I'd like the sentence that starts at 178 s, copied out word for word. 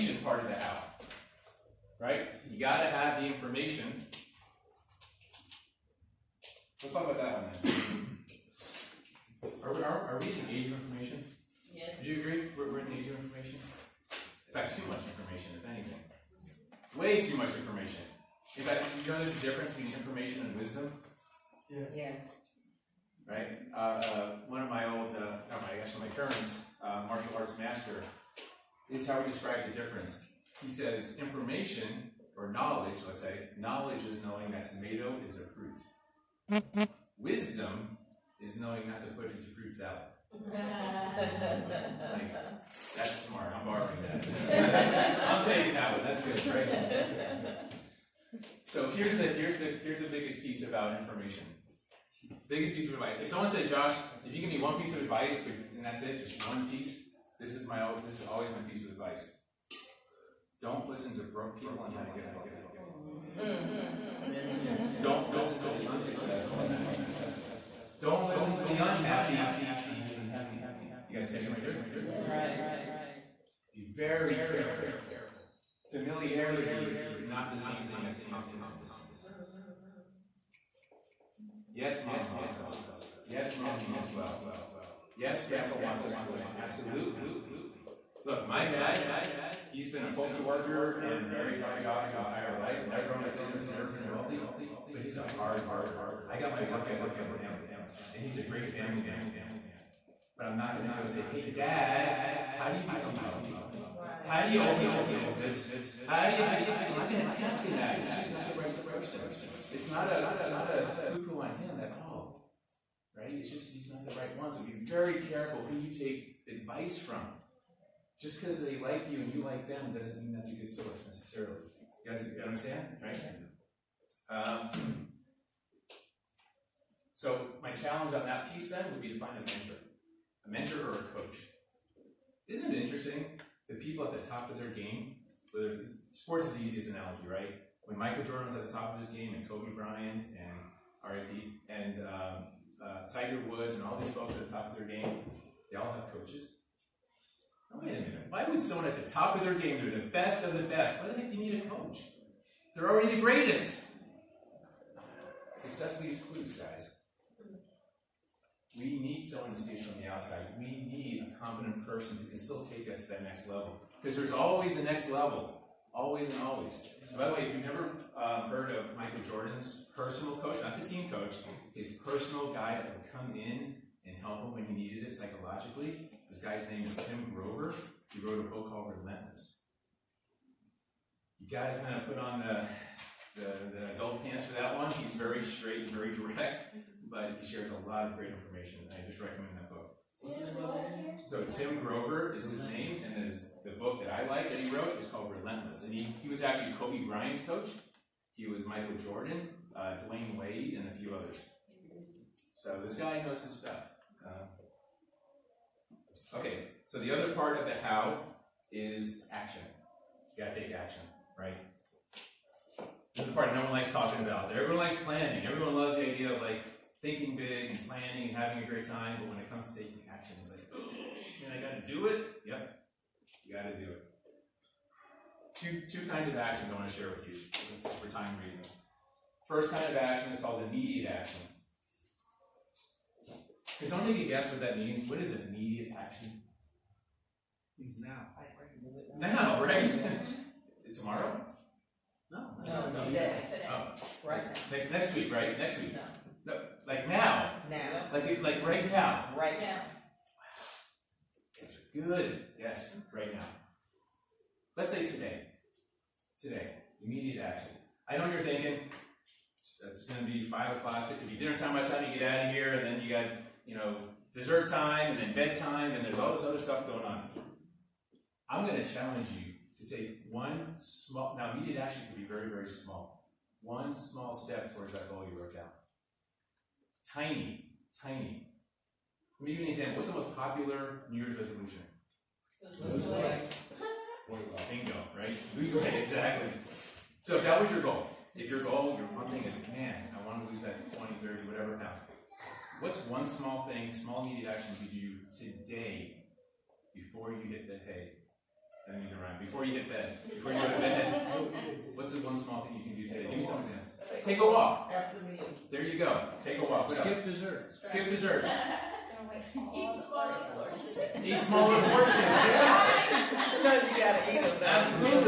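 He wrote a book called Relentless.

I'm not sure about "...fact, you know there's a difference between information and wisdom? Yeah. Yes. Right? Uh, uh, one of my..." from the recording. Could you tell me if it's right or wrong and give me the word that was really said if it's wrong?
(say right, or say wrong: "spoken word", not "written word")
right.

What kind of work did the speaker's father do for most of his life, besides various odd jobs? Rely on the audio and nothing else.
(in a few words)
postal worker.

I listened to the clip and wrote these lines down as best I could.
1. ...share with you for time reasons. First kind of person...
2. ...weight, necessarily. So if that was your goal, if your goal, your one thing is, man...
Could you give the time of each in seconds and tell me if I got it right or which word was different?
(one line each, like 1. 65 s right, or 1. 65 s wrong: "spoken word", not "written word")
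1. 226 s wrong: "action", not "person"
2. 285 s wrong: "exactly", not "necessarily".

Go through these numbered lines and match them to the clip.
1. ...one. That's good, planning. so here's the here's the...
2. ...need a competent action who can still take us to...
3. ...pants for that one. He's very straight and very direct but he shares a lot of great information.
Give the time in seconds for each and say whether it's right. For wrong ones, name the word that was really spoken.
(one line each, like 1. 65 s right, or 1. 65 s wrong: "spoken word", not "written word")
1. 45 s wrong: "training", not "planning"
2. 160 s wrong: "person", not "action"
3. 184 s right.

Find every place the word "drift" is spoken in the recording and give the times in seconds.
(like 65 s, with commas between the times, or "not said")
71 s.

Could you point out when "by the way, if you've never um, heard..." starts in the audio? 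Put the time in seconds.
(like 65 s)
167 s.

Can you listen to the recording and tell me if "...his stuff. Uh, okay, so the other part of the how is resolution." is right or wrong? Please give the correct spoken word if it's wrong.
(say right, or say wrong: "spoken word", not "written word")
wrong: "action", not "resolution".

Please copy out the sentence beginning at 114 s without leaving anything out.
So be very careful who you take advice from.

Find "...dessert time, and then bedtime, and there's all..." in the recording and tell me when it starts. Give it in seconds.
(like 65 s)
264 s.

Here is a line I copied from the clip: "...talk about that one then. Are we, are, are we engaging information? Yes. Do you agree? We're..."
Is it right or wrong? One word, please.
right.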